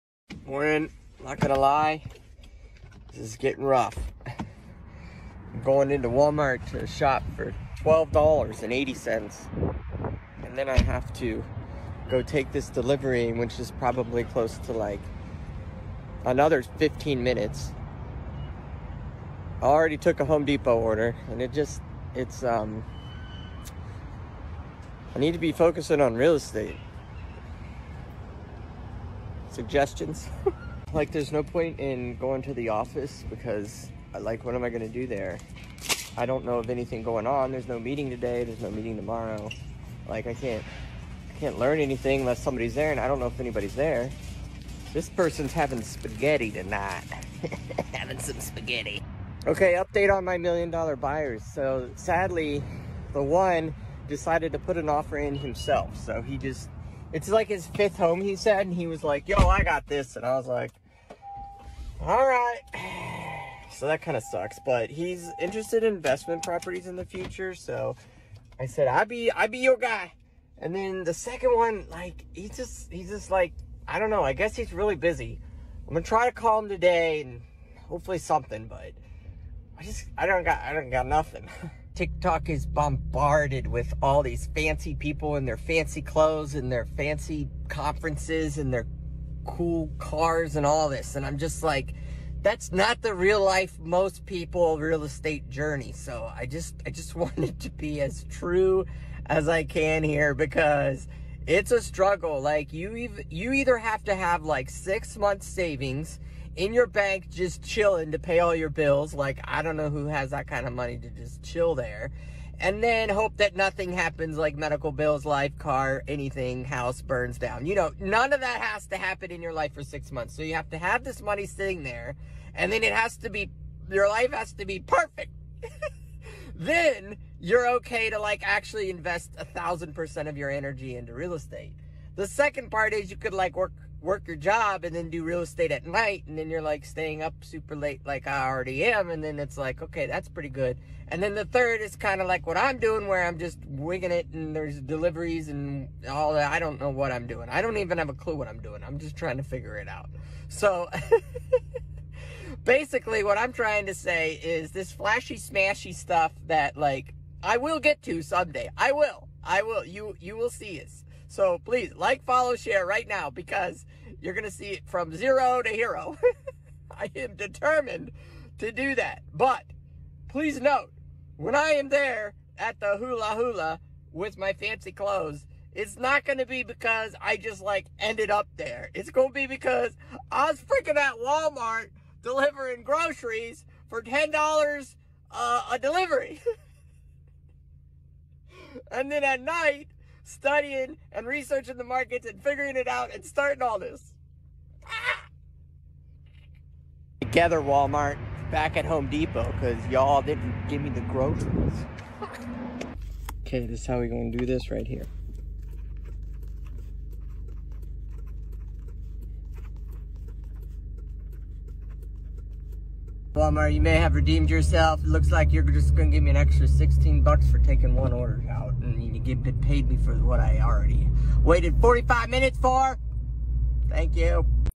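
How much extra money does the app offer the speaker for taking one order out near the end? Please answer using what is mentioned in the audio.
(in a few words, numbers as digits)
$16.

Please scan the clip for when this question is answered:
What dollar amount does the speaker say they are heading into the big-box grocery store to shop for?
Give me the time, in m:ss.
0:07.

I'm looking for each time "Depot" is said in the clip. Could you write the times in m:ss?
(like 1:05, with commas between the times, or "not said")
0:20, 3:19.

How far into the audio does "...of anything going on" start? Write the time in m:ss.
0:36.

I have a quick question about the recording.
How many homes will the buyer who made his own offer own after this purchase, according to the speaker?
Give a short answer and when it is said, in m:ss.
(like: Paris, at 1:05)
fifth home, at 0:57.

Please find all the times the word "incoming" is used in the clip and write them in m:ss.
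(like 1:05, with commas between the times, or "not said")
not said.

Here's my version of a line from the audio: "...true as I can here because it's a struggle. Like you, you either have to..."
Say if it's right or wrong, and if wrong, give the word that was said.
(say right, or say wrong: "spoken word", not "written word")
right.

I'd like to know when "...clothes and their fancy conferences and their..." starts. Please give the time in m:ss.
1:26.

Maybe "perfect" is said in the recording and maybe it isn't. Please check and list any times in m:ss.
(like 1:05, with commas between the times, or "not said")
2:04.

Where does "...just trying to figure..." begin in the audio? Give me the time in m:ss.
2:28.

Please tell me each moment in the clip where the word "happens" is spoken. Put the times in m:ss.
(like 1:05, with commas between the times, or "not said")
1:53, 1:58.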